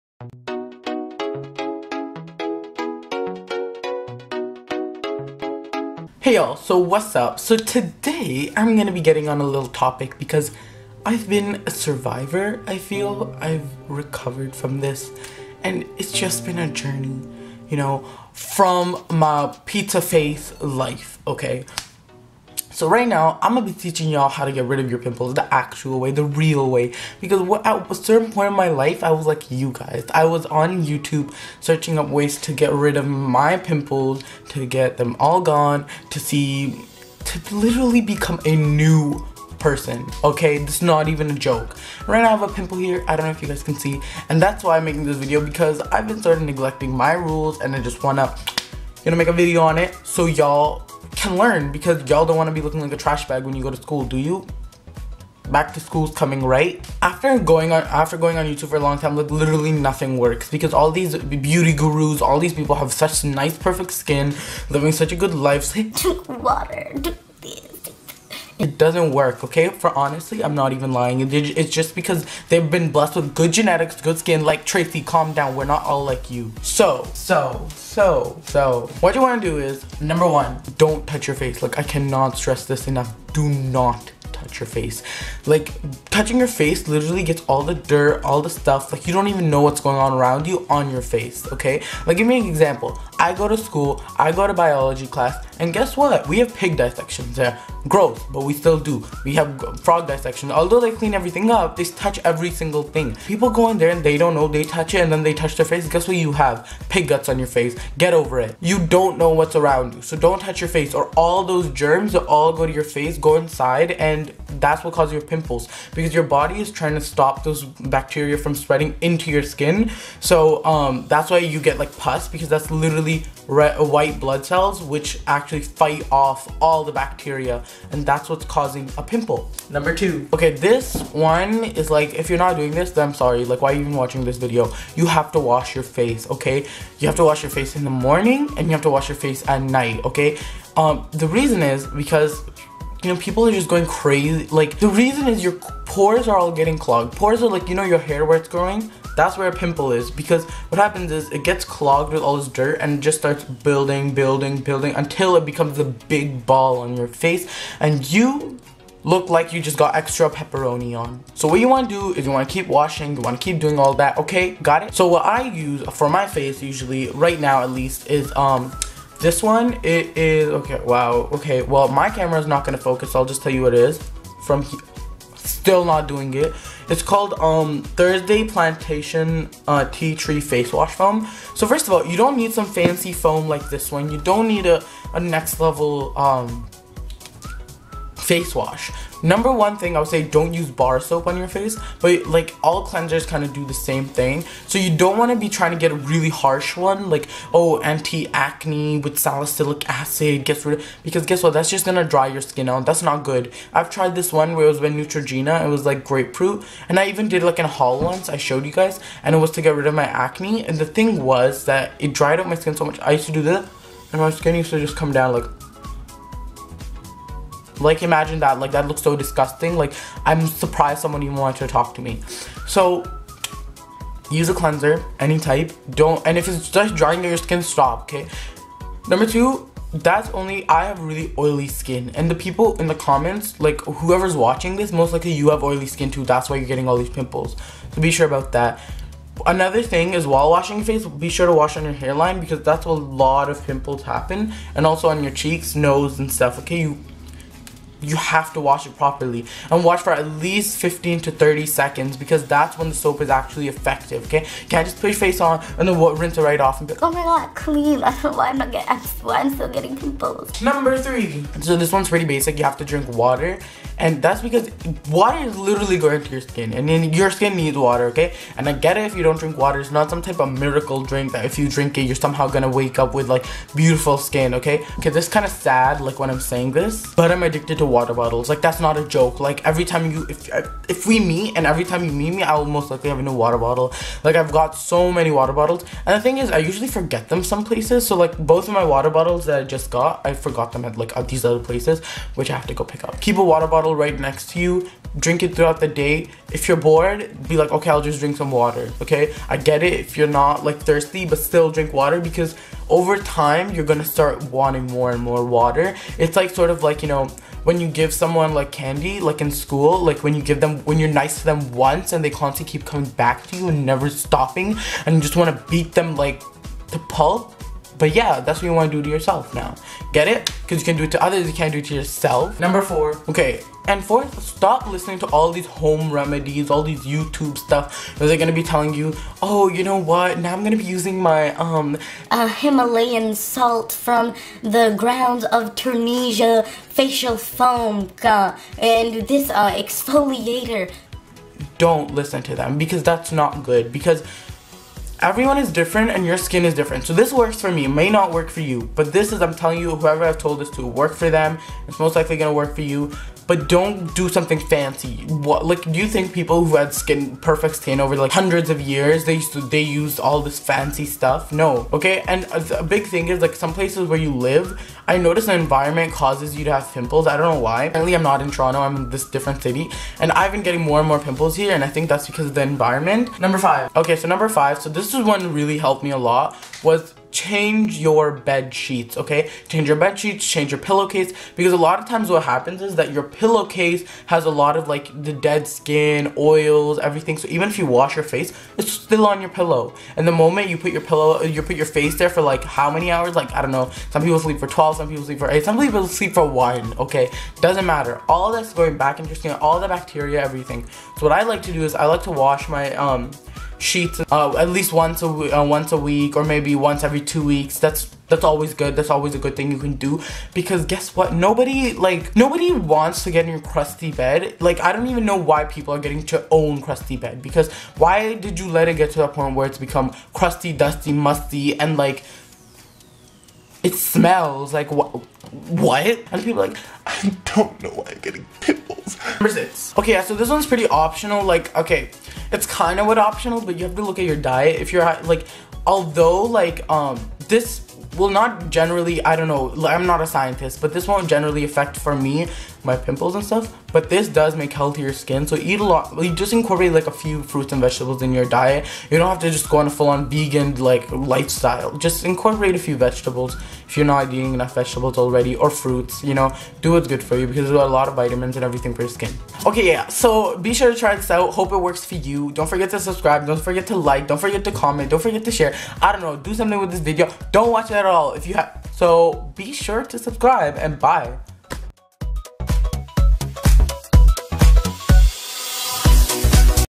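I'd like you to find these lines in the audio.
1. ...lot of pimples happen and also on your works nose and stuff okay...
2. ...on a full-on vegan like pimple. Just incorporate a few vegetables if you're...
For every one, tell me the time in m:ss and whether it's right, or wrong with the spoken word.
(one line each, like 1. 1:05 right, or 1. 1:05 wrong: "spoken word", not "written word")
1. 4:02 wrong: "cheeks", not "works"
2. 7:29 wrong: "lifestyle", not "pimple".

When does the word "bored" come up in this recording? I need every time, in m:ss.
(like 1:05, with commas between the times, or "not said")
4:56.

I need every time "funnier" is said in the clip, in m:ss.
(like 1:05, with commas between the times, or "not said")
not said.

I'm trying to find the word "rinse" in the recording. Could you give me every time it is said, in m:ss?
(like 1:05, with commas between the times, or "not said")
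4:16.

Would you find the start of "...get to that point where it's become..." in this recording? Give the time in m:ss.
6:58.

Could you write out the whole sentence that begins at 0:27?
Because what, at a certain point in my life, I was like you guys.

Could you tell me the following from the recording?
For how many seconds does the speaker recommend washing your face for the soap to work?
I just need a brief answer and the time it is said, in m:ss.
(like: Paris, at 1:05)
15 to 30 seconds, at 4:10.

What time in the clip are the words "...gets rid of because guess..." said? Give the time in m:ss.
3:20.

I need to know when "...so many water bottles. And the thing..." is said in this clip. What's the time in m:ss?
4:44.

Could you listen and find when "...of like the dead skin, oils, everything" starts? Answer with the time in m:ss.
6:24.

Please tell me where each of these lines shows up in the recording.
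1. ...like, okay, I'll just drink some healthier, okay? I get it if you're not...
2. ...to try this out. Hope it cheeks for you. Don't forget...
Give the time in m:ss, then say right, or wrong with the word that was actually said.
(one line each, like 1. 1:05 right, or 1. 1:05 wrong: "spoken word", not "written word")
1. 4:57 wrong: "water", not "healthier"
2. 7:40 wrong: "works", not "cheeks".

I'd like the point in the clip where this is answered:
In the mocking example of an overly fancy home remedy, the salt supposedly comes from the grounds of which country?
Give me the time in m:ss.
5:35.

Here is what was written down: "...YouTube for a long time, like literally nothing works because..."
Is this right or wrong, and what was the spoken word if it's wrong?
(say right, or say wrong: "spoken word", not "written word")
right.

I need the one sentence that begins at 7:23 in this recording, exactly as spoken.
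But this does make healthier skin.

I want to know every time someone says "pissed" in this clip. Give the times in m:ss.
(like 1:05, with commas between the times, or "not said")
not said.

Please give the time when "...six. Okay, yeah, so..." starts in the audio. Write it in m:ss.
7:09.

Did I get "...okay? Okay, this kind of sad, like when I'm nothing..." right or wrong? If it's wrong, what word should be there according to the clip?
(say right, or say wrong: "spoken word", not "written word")
wrong: "saying", not "nothing".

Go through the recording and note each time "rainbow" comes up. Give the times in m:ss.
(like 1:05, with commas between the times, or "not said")
not said.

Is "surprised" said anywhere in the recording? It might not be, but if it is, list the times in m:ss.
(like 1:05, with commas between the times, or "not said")
3:40.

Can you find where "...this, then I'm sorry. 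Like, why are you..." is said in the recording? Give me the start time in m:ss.
2:12.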